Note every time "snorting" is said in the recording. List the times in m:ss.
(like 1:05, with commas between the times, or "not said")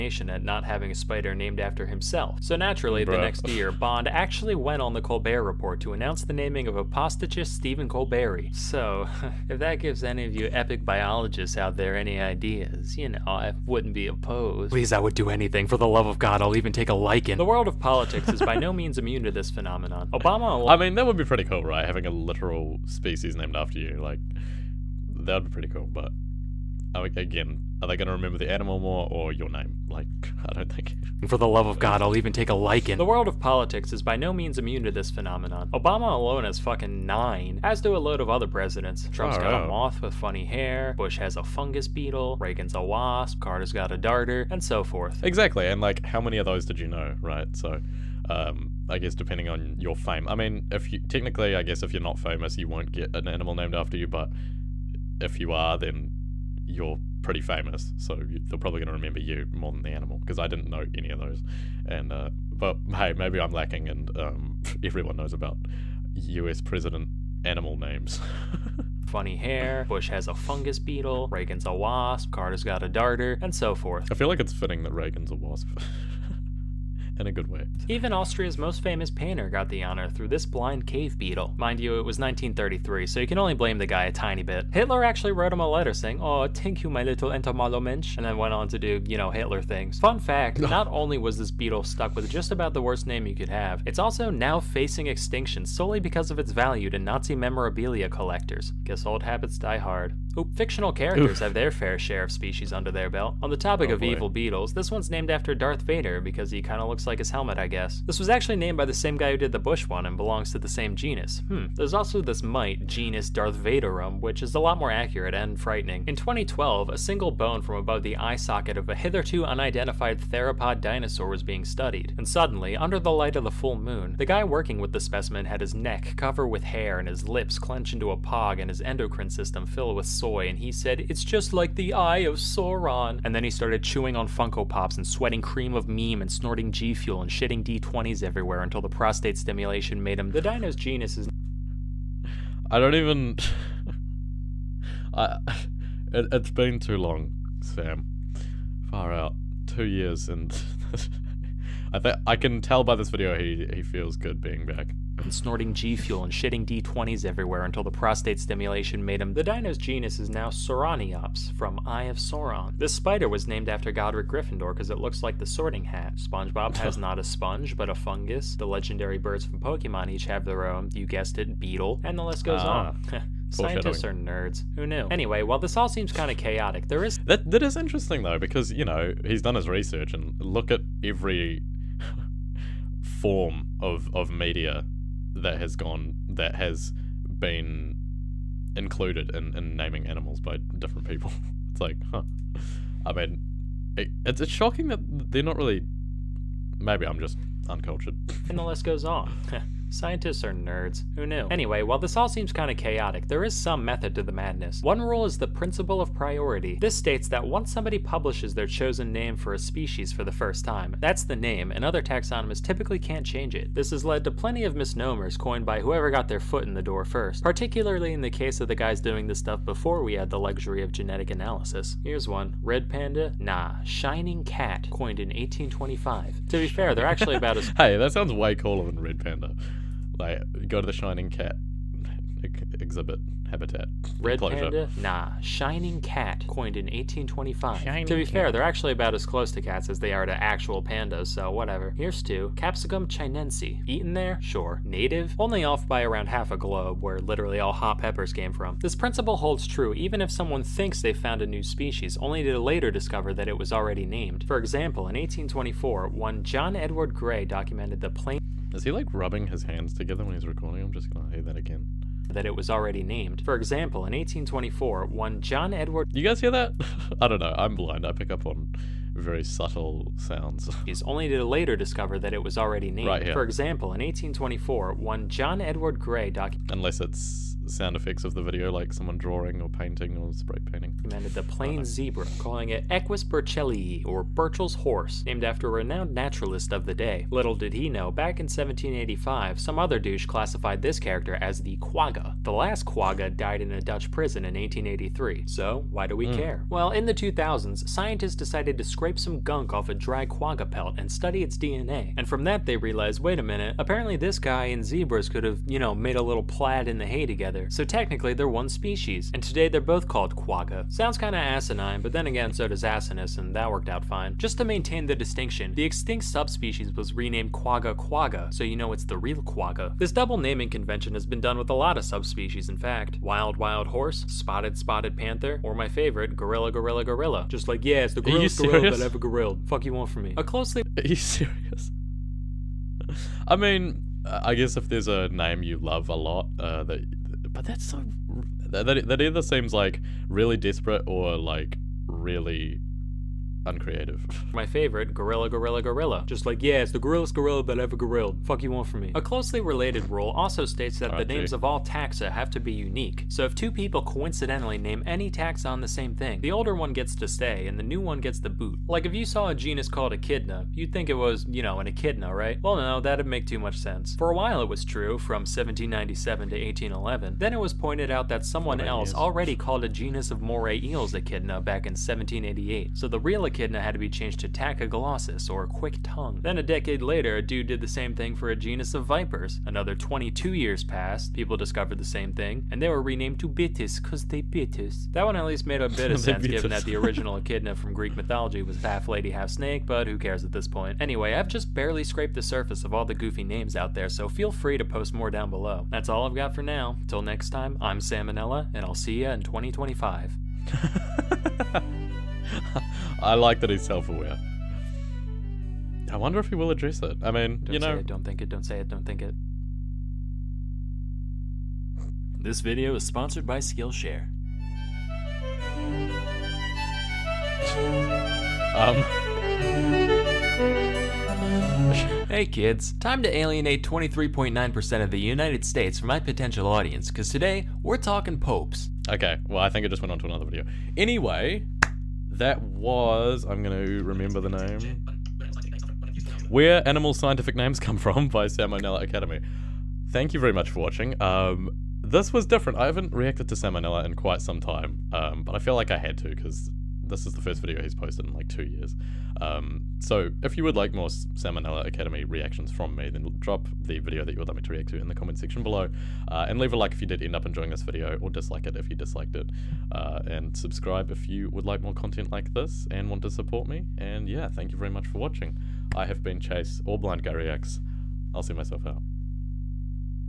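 2:16, 2:35.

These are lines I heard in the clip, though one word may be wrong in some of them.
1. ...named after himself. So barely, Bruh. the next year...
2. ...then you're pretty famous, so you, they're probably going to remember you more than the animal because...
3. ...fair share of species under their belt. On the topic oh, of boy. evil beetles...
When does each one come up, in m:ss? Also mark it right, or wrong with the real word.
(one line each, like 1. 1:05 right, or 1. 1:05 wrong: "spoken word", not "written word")
1. 0:01 wrong: "naturally", not "barely"
2. 0:55 right
3. 1:41 right.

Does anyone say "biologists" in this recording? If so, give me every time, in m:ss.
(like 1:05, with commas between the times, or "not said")
0:10.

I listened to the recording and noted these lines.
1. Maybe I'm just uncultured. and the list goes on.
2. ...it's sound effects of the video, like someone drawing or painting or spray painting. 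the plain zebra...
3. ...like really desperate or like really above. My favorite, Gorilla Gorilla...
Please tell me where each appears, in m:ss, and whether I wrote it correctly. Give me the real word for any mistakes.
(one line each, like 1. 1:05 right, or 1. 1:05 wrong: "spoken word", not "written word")
1. 3:16 right
2. 4:37 right
3. 5:39 wrong: "uncreative", not "above".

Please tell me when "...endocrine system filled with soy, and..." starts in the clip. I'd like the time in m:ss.
2:08.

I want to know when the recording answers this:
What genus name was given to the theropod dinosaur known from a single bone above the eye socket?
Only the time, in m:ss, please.
2:40.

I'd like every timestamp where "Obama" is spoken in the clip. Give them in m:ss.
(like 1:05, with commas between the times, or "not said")
0:20, 0:35.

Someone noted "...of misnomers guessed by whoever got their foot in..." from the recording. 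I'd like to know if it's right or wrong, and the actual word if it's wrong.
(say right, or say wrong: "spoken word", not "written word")
wrong: "coined", not "guessed".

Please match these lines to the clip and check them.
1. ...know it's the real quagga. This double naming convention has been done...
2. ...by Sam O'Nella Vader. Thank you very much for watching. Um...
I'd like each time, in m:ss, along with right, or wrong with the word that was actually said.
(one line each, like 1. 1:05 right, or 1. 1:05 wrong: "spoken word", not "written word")
1. 5:18 right
2. 7:18 wrong: "Academy", not "Vader".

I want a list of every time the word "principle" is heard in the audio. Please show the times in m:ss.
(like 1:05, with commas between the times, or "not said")
3:25, 4:08.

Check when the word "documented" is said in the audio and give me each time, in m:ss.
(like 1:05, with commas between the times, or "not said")
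4:17, 4:36.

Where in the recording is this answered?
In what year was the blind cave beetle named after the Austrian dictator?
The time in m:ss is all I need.
1:22.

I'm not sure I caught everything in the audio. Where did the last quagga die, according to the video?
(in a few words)
A Dutch prison.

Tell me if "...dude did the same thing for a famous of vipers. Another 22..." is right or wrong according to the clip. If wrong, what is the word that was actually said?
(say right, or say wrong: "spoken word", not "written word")
wrong: "genus", not "famous".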